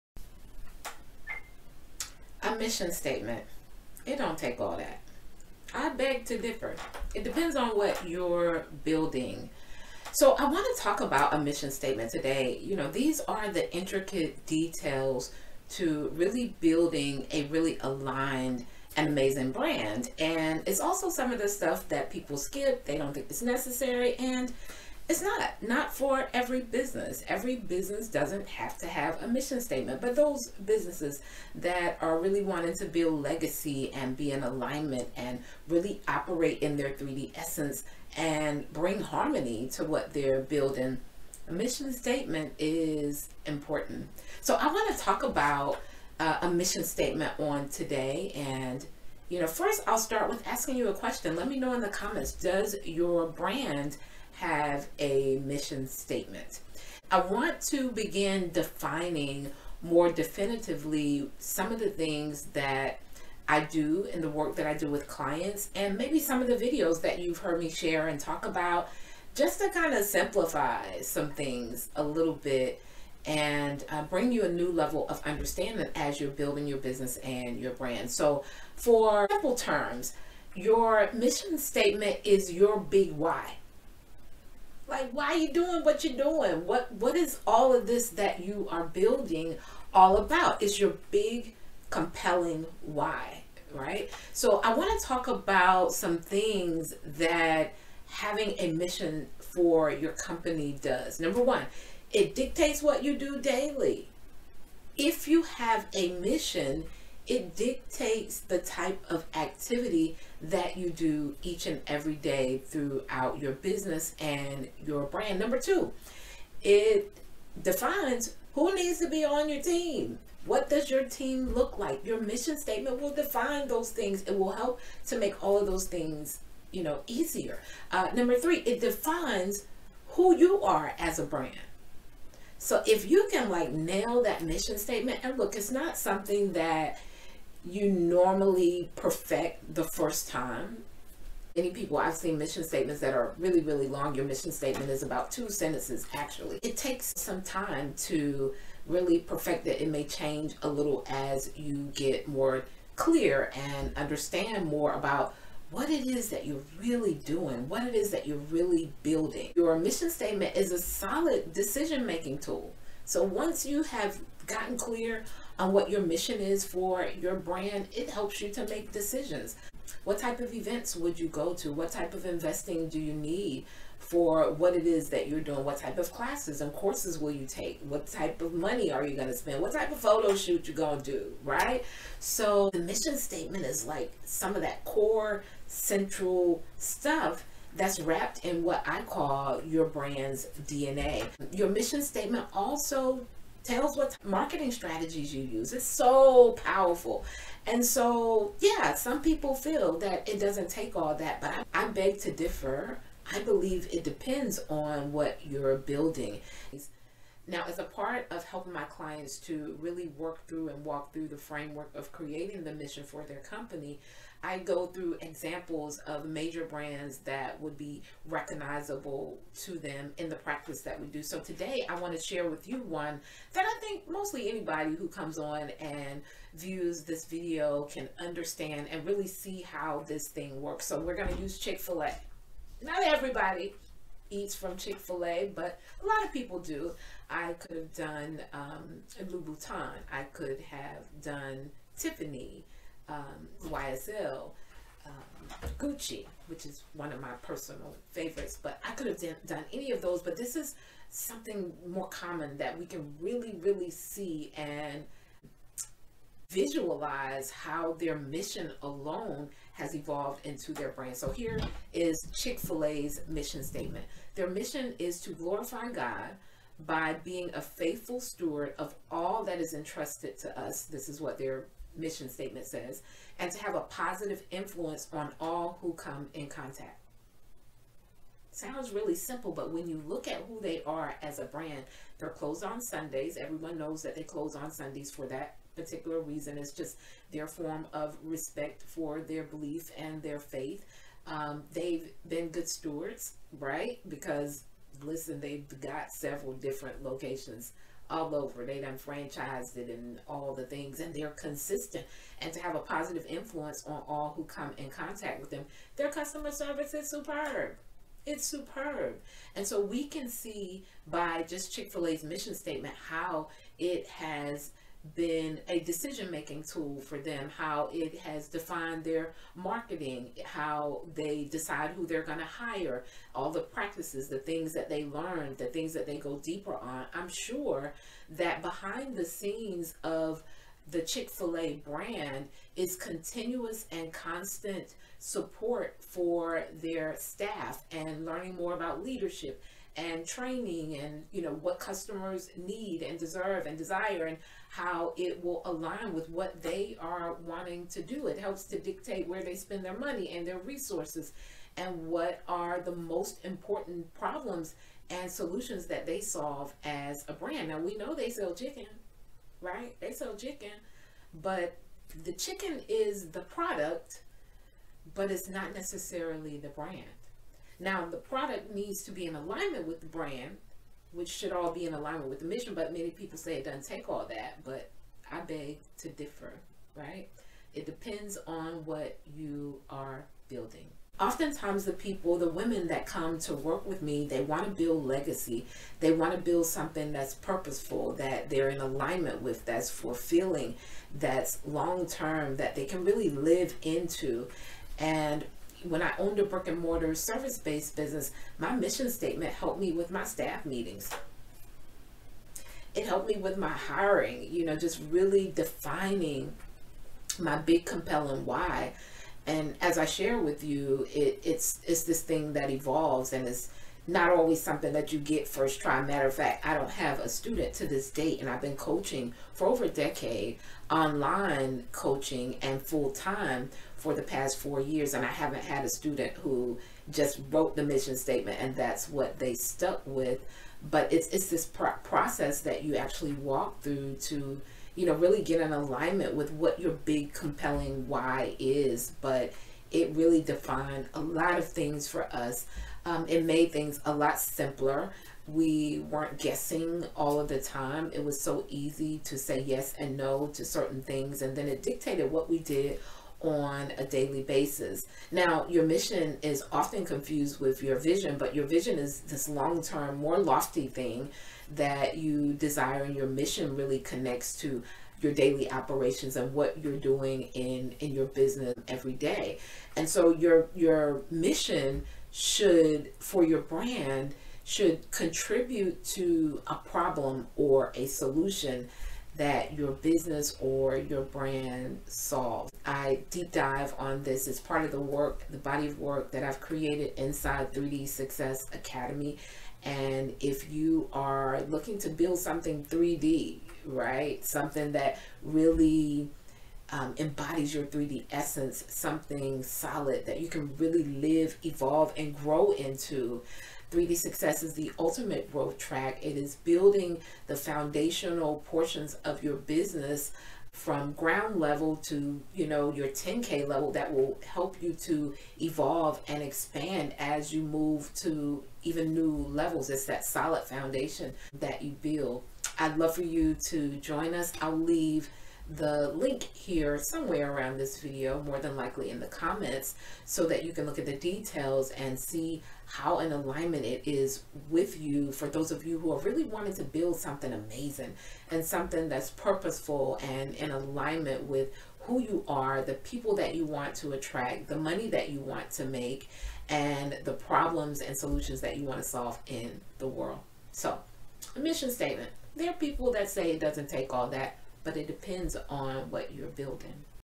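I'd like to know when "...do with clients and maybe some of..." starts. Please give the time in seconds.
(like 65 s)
64 s.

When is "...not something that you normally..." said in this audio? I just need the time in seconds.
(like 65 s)
135 s.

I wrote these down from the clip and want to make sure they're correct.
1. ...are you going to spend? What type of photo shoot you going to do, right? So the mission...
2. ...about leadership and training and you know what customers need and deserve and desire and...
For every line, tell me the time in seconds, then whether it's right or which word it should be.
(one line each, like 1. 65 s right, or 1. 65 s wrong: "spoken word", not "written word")
1. 178 s right
2. 338 s right.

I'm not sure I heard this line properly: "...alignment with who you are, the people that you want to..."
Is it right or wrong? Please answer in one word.
right.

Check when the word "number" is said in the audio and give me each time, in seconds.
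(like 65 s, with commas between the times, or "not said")
101 s, 115 s, 128 s.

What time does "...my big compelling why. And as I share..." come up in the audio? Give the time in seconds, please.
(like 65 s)
407 s.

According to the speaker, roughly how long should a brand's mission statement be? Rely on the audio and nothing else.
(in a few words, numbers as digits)
2 sentences.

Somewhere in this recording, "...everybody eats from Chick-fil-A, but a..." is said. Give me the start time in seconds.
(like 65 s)
233 s.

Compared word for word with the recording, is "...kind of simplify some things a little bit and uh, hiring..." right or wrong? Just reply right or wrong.
wrong.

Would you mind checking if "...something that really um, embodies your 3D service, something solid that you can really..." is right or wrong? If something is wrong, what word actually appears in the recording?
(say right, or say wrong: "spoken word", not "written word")
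wrong: "essence", not "service".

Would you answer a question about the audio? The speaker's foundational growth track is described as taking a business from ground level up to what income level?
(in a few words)
10k level.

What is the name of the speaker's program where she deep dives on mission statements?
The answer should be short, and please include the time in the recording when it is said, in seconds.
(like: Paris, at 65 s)
3D Success Academy, at 487 s.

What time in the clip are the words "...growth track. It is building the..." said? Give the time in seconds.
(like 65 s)
505 s.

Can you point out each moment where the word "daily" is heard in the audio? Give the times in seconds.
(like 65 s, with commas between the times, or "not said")
103 s, 454 s, 465 s.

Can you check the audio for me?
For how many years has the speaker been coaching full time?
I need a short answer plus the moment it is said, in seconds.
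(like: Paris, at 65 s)
4, at 424 s.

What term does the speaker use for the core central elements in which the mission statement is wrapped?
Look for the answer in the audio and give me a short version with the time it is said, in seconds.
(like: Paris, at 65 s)
brand's DNA, at 189 s.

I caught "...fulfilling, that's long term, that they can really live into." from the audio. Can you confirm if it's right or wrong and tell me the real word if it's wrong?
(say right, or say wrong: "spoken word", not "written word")
right.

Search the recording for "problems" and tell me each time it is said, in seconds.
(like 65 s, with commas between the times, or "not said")
354 s, 476 s, 547 s.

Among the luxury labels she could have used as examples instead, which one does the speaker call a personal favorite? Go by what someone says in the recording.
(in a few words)
Gucci.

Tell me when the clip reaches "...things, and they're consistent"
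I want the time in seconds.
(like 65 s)
300 s.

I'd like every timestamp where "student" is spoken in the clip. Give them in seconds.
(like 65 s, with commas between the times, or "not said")
417 s, 425 s.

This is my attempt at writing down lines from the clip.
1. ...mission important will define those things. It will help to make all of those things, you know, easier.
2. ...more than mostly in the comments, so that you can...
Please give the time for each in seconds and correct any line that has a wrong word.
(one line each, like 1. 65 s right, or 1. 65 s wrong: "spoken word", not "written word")
1. 122 s wrong: "statement", not "important"
2. 528 s wrong: "likely", not "mostly".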